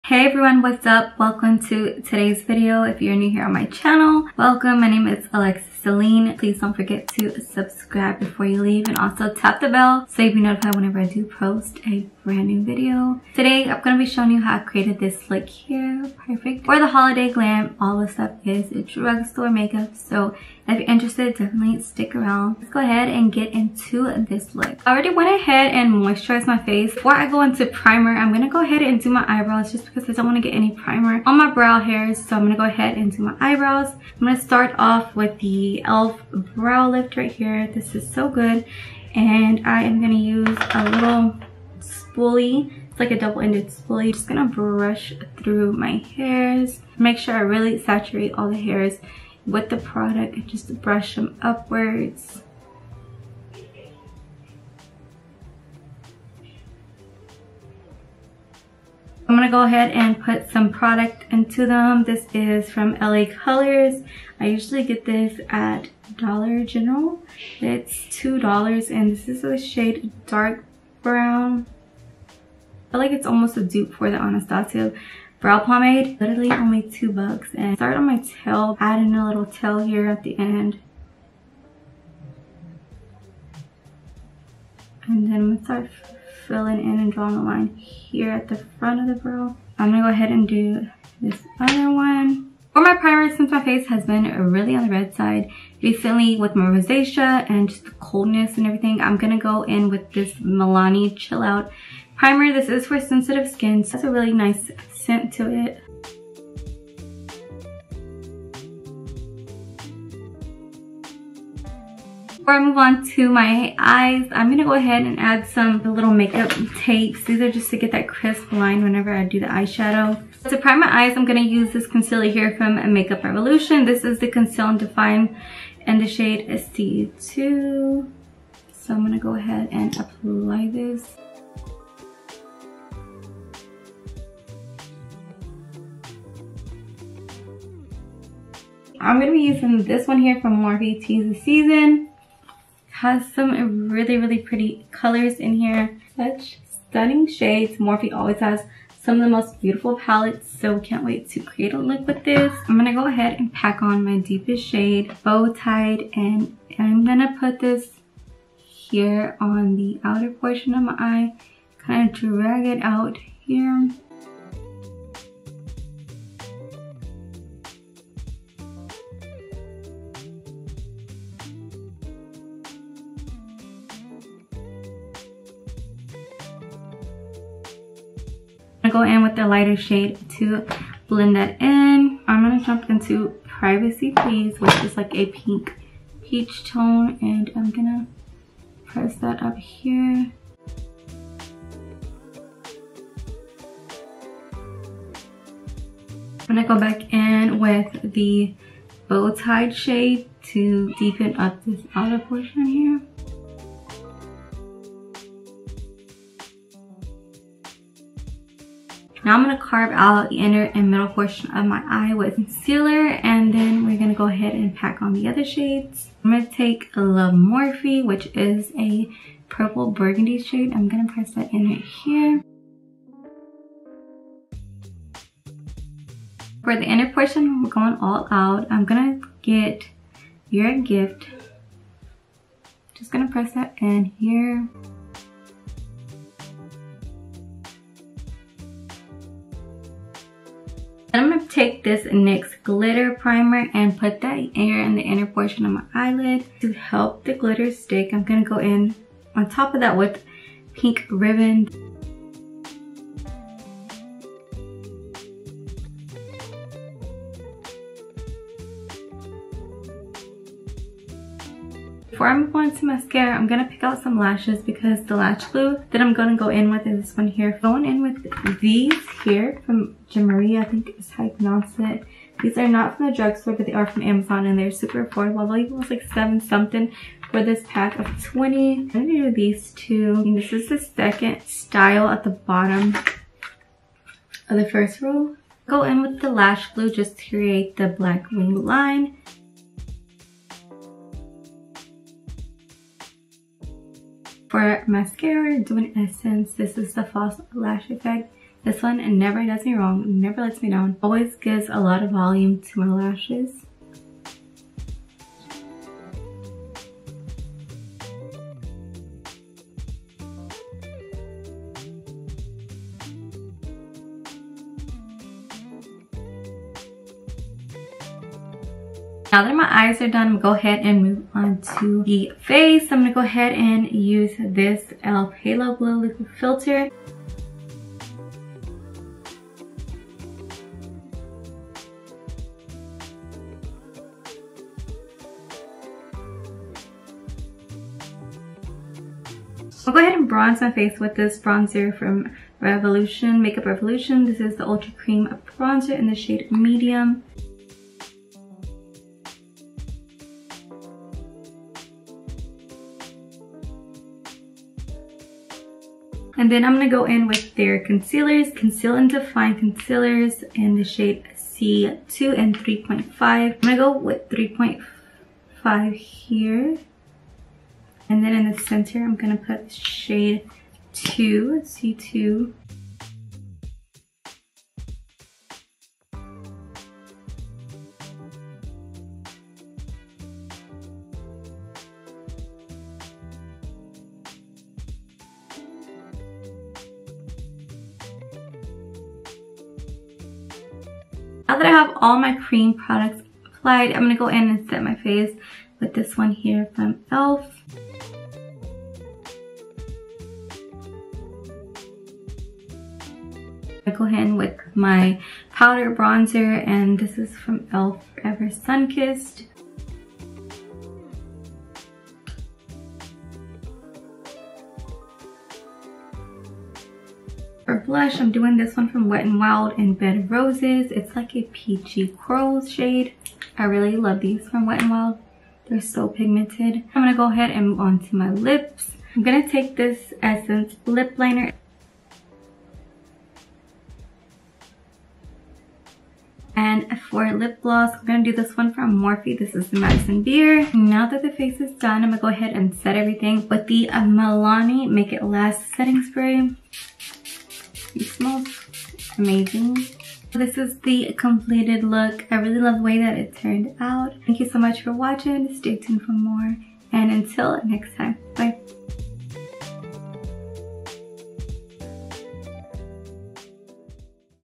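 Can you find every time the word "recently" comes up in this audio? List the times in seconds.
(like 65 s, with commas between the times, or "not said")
95 s.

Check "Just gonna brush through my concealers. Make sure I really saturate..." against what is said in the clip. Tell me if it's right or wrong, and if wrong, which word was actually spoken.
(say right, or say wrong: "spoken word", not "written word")
wrong: "hairs", not "concealers".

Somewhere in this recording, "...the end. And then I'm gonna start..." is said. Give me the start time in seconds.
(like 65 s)
80 s.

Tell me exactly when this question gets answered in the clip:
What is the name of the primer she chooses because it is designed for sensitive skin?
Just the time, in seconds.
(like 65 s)
100 s.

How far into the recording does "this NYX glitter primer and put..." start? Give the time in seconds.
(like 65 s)
241 s.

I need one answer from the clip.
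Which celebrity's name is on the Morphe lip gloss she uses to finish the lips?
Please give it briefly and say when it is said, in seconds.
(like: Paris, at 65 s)
Madison Beer, at 439 s.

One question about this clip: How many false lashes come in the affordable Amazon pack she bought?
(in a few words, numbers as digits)
20.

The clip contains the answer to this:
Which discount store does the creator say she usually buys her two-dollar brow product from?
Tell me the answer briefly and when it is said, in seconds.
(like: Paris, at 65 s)
Dollar General, at 66 s.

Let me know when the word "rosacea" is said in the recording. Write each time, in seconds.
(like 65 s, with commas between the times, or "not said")
96 s.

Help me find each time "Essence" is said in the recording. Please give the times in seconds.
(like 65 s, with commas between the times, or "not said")
295 s, 430 s.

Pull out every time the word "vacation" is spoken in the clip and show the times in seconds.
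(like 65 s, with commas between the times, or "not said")
not said.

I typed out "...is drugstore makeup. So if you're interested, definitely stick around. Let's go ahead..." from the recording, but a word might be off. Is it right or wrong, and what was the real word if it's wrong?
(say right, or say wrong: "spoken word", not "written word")
right.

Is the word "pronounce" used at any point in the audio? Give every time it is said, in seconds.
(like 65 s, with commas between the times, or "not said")
271 s.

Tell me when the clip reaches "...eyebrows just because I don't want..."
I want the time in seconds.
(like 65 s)
29 s.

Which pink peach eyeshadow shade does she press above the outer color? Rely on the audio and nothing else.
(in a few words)
Privacy Please.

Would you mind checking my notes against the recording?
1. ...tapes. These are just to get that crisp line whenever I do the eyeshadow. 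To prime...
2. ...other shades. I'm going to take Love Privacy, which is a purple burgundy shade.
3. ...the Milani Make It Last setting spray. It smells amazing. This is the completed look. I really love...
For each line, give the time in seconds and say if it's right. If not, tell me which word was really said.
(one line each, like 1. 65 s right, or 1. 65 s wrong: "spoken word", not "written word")
1. 116 s right
2. 215 s wrong: "Morphe", not "Privacy"
3. 443 s right.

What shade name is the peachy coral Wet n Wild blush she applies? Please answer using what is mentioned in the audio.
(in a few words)
Bed of Roses.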